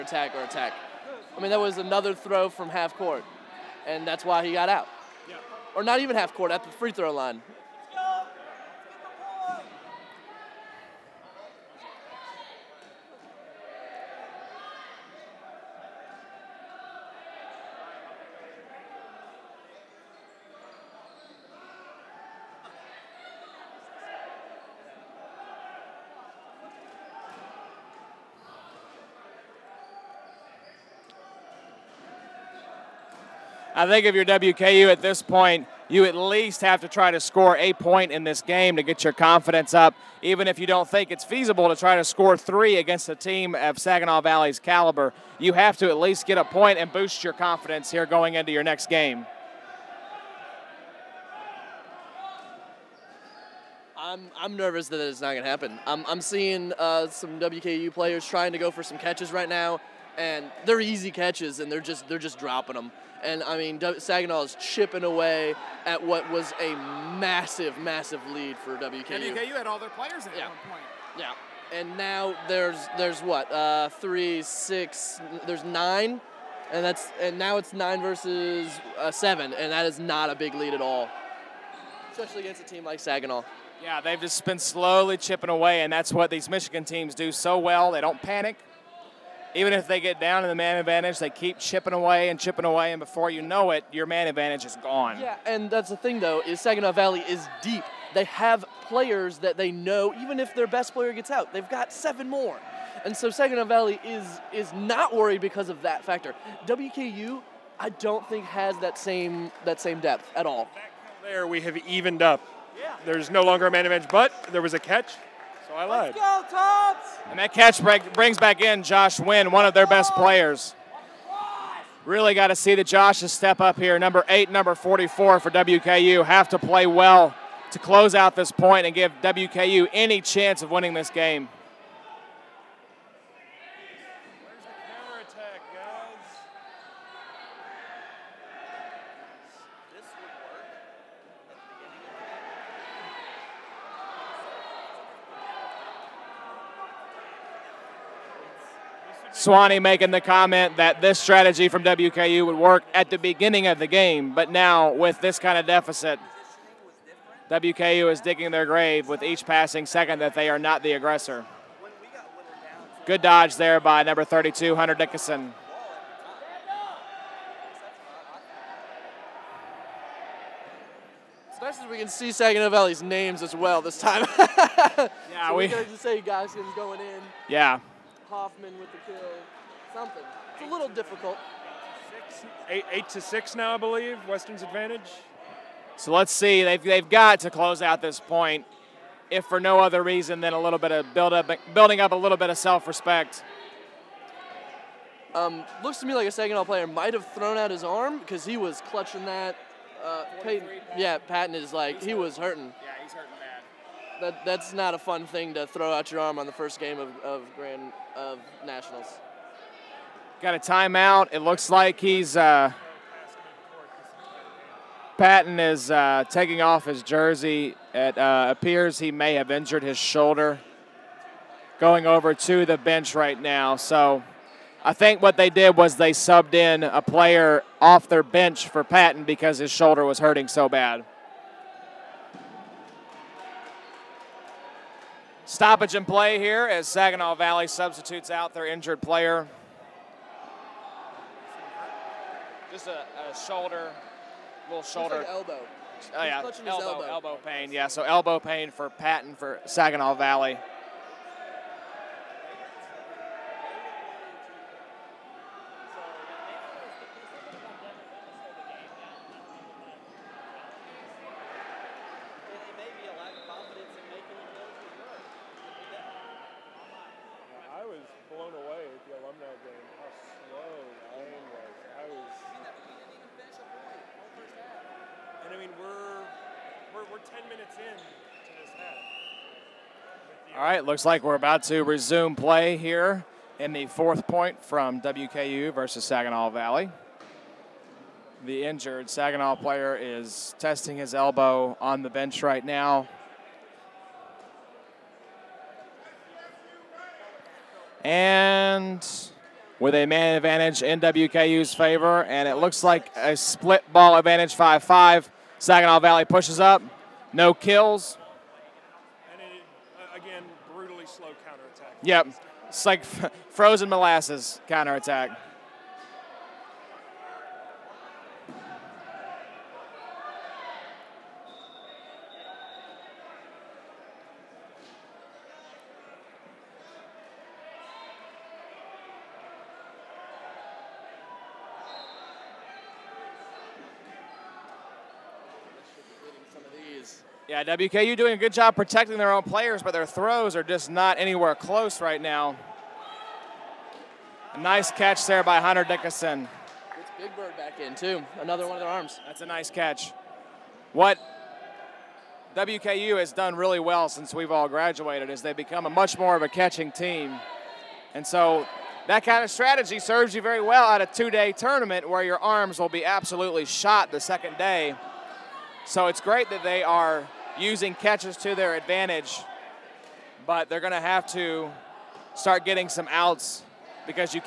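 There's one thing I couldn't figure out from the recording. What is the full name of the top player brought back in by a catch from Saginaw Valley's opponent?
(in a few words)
Josh Wynn.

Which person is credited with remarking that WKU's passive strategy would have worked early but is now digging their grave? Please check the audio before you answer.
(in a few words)
Swanee.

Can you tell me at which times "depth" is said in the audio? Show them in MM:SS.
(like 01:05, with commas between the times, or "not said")
01:50.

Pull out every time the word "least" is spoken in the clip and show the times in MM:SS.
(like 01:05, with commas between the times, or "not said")
00:36, 00:45.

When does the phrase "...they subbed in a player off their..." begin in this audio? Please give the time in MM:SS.
03:45.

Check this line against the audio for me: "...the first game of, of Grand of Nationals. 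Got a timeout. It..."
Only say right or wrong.
right.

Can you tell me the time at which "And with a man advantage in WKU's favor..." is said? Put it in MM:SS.
04:58.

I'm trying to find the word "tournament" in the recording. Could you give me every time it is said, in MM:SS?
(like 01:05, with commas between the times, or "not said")
06:01.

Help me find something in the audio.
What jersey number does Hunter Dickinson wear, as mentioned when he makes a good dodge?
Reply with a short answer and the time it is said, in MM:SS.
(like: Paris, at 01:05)
32, at 02:44.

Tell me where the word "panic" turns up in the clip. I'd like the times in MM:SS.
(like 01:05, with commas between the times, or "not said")
01:28.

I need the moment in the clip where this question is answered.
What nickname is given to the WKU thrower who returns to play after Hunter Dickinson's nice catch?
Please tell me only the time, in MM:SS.
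05:47.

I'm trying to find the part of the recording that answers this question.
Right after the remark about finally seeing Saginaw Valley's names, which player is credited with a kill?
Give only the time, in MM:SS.
02:58.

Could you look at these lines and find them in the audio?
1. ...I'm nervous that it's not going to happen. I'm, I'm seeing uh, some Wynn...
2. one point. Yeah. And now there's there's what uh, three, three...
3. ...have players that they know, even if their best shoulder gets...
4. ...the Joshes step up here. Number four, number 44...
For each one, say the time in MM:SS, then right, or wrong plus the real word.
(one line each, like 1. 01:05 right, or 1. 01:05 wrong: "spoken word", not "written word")
1. 00:54 wrong: "WKU", not "Wynn"
2. 01:10 wrong: "six", not "three"
3. 01:38 wrong: "player", not "shoulder"
4. 02:02 wrong: "eight", not "four".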